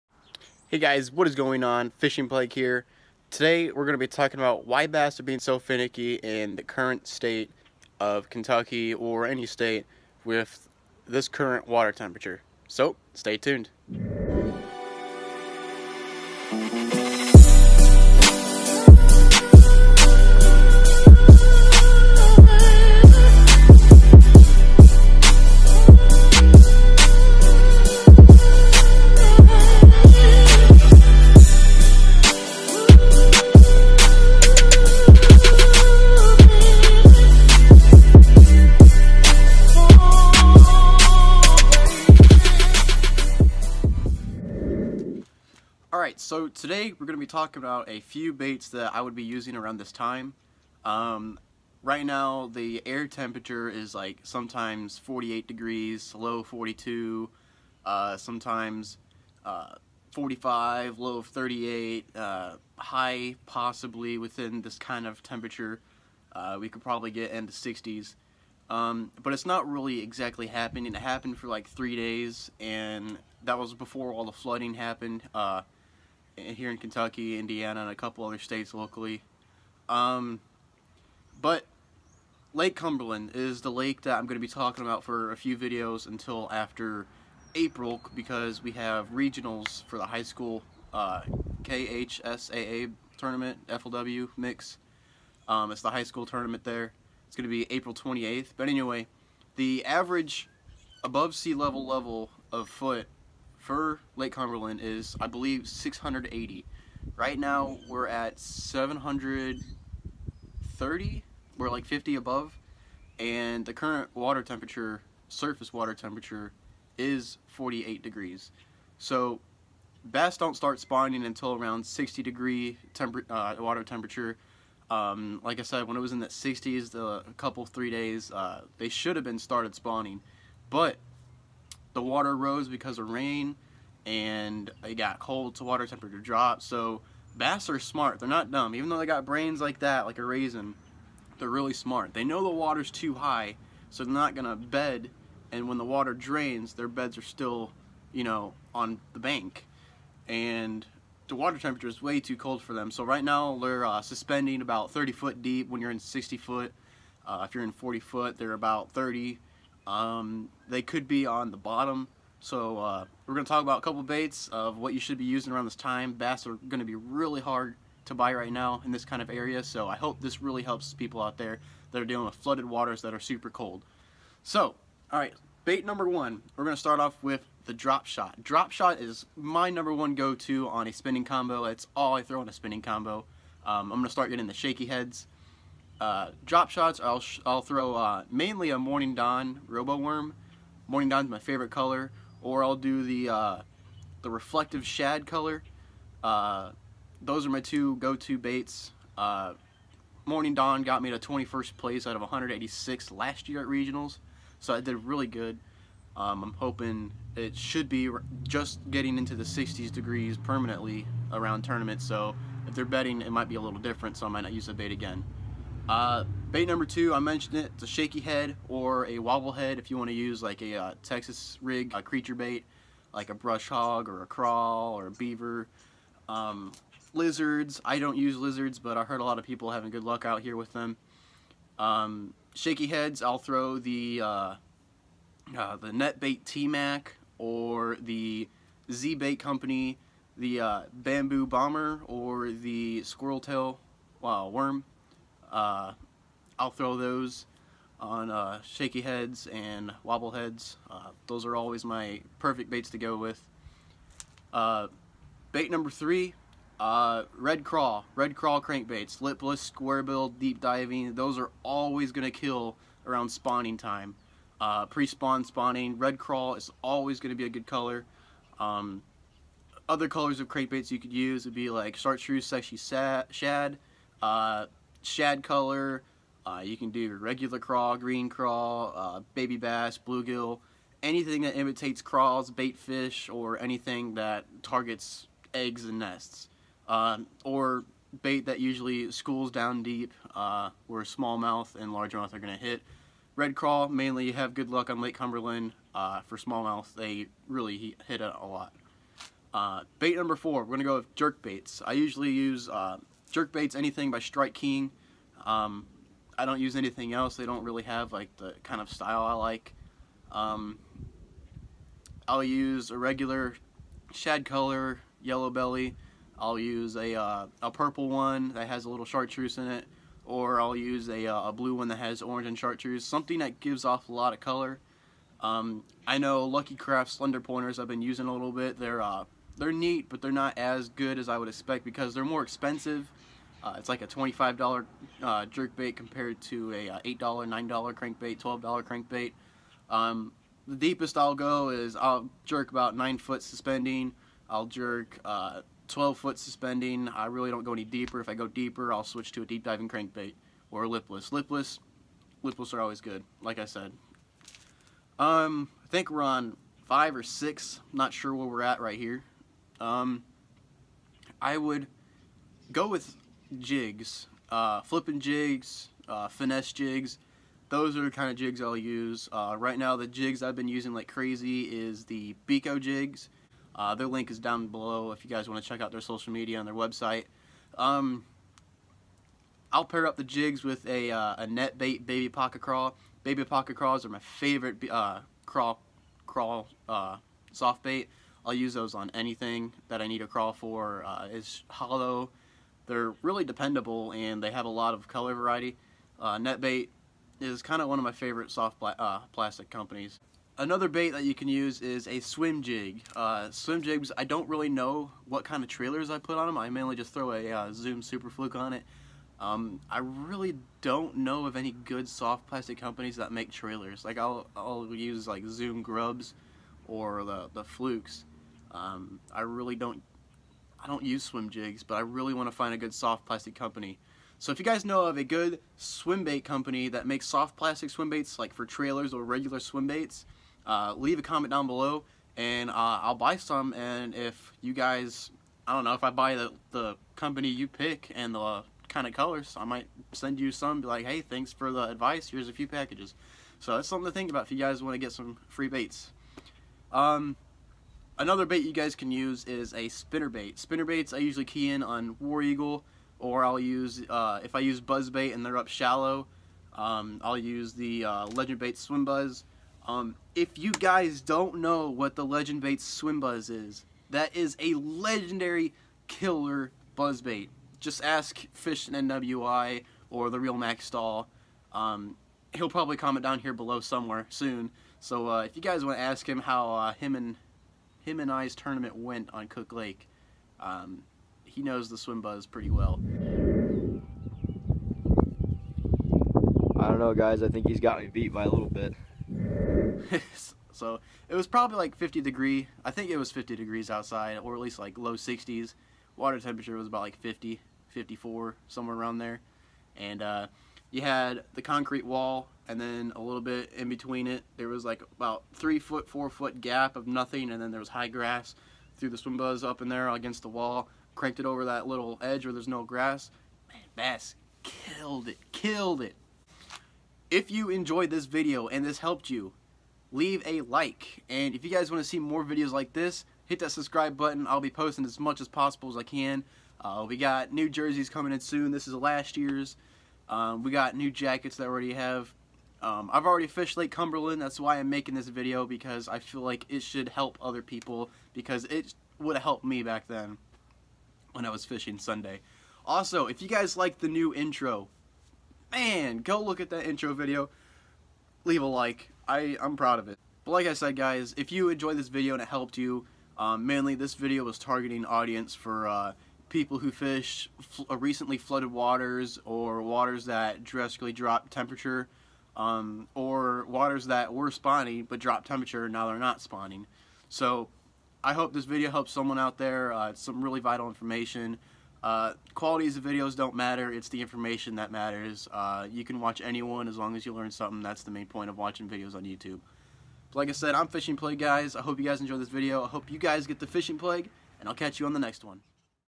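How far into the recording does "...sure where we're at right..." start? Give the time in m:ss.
5:58.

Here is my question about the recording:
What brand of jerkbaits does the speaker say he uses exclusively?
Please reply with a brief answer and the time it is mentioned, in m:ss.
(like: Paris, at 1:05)
Strike King, at 5:04.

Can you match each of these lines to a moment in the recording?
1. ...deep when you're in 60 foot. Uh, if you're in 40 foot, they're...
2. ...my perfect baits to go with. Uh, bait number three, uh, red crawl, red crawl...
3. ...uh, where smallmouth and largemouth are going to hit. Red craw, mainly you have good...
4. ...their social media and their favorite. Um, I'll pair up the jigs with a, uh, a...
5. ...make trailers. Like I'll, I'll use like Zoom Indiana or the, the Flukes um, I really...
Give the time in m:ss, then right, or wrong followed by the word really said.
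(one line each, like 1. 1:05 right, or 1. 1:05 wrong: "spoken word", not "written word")
1. 2:35 right
2. 4:11 right
3. 4:50 right
4. 6:15 wrong: "website", not "favorite"
5. 6:53 wrong: "Grubs", not "Indiana".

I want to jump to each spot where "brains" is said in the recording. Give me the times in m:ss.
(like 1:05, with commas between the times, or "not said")
2:19.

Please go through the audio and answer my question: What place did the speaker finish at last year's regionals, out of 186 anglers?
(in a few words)
21st.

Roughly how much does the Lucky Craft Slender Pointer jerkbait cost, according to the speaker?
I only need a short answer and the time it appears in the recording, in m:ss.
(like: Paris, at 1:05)
$25, at 5:34.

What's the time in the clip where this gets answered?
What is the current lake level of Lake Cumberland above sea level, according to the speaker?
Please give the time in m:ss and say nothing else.
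1:48.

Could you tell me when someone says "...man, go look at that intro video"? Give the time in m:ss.
9:05.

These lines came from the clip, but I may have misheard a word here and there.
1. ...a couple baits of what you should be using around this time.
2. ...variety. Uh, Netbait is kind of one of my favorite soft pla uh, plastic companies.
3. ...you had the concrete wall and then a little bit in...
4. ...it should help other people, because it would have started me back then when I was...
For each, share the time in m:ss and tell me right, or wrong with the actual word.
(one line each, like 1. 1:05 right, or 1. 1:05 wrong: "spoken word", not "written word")
1. 2:43 right
2. 6:35 right
3. 8:20 right
4. 8:56 wrong: "helped", not "started".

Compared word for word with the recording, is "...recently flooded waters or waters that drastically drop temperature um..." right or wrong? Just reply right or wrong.
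right.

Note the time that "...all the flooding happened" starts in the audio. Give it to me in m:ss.
1:14.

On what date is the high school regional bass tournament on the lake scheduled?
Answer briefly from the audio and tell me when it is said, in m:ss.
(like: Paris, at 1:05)
April 28th, at 1:37.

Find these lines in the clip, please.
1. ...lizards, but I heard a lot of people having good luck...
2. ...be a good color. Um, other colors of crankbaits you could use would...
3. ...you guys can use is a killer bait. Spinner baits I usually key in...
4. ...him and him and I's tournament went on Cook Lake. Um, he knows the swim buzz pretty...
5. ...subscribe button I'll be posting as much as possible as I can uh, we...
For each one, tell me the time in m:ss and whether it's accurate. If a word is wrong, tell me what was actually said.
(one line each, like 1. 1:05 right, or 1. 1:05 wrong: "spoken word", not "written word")
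1. 3:48 right
2. 4:27 right
3. 7:28 wrong: "spinner", not "killer"
4. 7:56 right
5. 8:43 right.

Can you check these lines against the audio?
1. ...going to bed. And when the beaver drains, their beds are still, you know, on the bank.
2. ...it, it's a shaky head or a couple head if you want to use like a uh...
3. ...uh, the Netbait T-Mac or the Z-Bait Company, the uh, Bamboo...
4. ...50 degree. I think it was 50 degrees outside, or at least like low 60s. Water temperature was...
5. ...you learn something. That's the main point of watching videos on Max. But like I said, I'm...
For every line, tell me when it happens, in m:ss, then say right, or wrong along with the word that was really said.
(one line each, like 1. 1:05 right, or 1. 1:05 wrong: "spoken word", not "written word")
1. 2:24 wrong: "water", not "beaver"
2. 3:37 wrong: "wobble", not "couple"
3. 3:55 right
4. 8:11 right
5. 9:37 wrong: "YouTube", not "Max".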